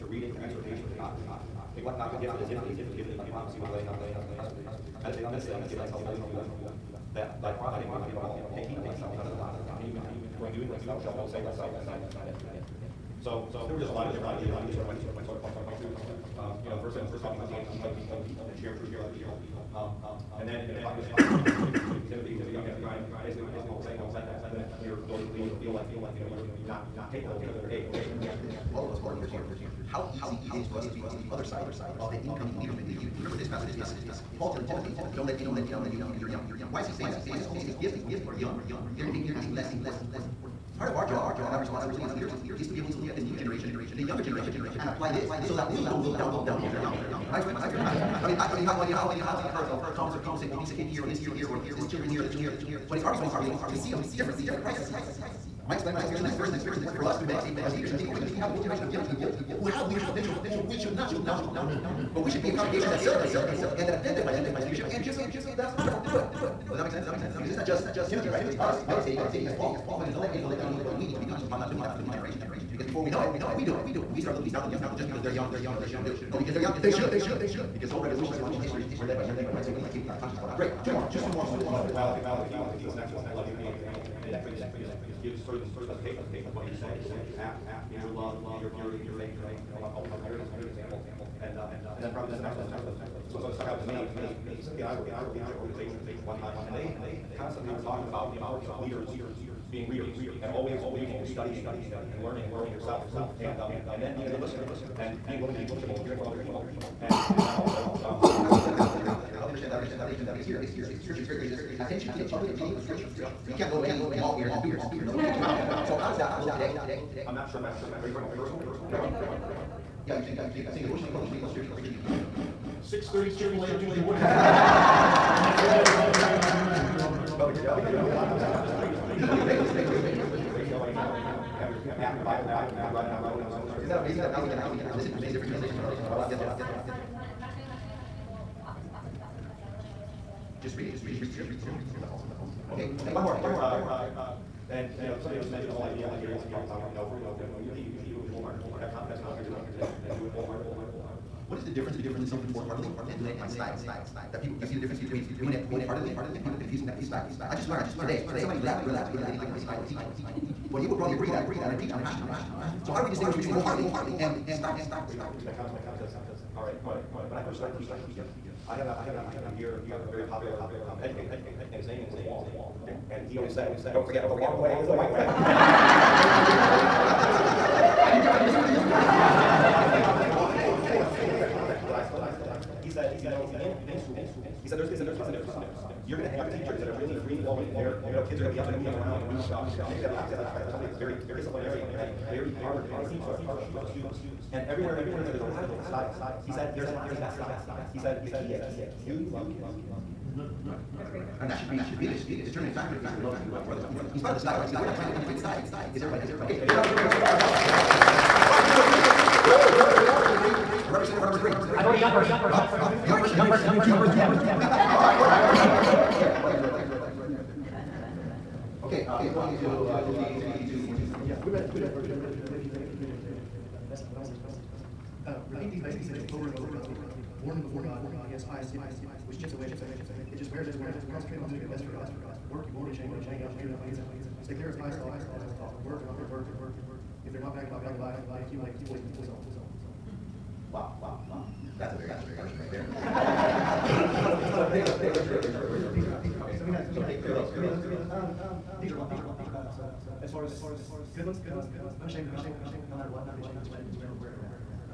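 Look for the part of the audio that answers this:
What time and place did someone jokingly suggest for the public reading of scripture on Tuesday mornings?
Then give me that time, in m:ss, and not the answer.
2:02.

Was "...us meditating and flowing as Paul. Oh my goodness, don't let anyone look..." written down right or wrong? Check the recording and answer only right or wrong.
wrong.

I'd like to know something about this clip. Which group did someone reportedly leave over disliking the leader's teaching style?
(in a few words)
Relevance.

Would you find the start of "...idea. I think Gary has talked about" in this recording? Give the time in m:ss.
2:25.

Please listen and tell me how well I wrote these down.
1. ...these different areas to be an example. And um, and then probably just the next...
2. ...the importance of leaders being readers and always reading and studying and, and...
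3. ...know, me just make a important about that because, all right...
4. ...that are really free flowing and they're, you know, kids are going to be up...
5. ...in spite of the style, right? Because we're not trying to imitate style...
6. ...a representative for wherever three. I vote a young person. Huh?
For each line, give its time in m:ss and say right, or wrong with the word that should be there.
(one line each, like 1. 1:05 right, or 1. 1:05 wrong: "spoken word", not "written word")
1. 1:30 right
2. 1:38 right
3. 2:45 wrong: "comment", not "important"
4. 3:06 right
5. 3:24 right
6. 3:30 wrong: "number", not "wherever".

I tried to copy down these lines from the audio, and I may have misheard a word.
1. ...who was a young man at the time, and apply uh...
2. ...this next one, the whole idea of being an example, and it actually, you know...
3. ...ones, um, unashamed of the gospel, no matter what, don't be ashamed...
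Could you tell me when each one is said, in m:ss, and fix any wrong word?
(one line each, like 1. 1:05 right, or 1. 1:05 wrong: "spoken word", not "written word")
1. 0:22 wrong: "basically", not "apply"
2. 1:22 right
3. 4:11 right.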